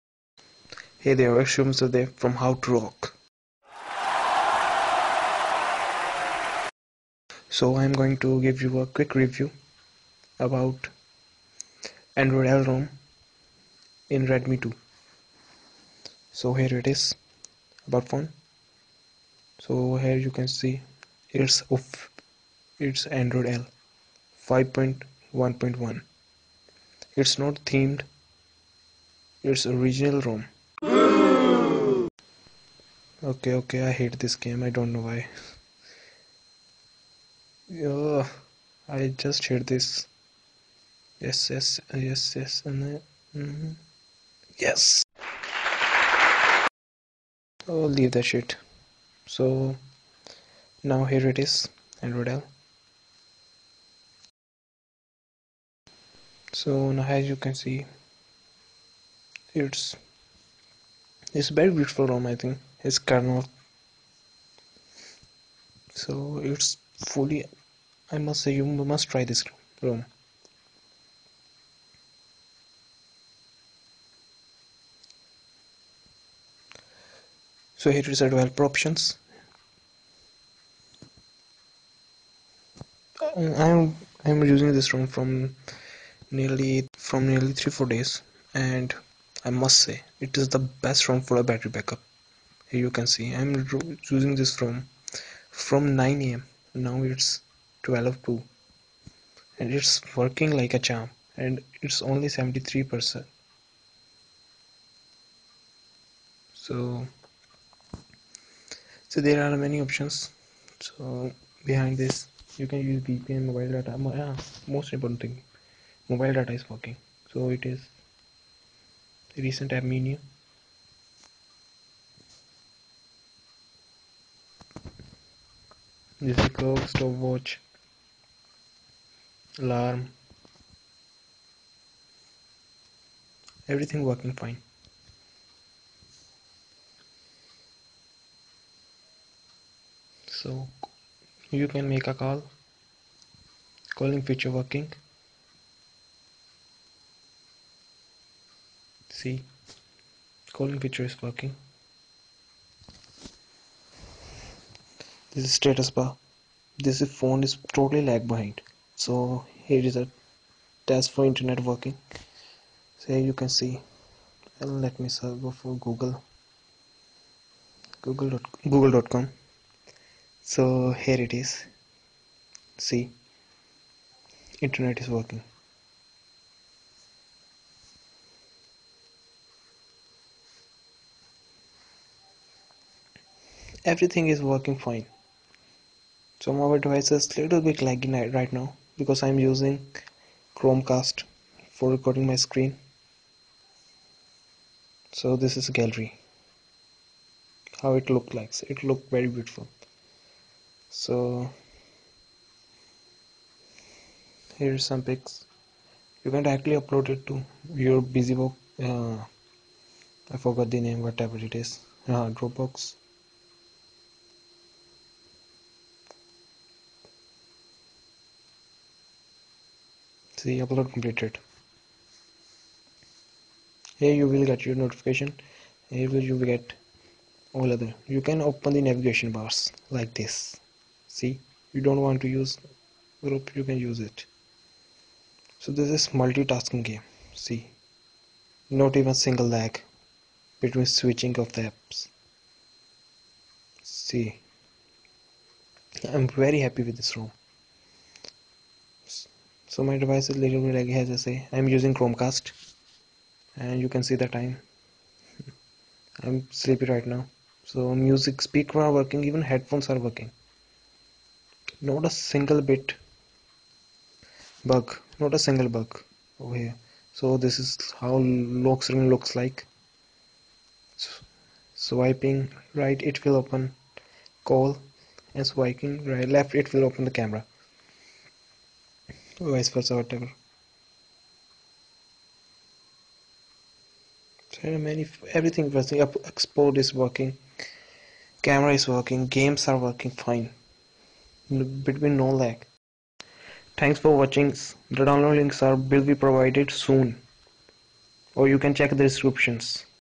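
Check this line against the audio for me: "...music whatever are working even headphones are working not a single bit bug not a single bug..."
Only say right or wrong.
wrong.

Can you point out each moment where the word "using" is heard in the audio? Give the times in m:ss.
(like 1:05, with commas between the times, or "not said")
1:24, 3:09, 4:11.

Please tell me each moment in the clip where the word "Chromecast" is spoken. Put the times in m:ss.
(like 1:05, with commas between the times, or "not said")
3:10, 4:11.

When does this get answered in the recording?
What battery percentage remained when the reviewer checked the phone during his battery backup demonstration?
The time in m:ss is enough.
1:42.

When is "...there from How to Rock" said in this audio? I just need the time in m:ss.
0:01.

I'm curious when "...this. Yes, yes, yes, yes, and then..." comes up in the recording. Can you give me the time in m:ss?
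0:39.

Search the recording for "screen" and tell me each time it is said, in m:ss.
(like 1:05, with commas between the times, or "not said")
3:12, 4:28.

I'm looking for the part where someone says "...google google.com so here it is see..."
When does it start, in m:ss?
2:48.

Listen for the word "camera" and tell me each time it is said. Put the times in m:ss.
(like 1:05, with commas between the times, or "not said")
4:37, 4:48.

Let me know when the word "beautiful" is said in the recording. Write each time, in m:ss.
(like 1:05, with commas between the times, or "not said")
1:01, 3:19.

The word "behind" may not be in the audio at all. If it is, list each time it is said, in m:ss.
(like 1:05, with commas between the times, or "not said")
1:51, 2:38.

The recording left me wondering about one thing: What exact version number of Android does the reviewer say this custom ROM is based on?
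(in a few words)
5.1.1.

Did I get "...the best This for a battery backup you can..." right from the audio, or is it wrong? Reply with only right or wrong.
wrong.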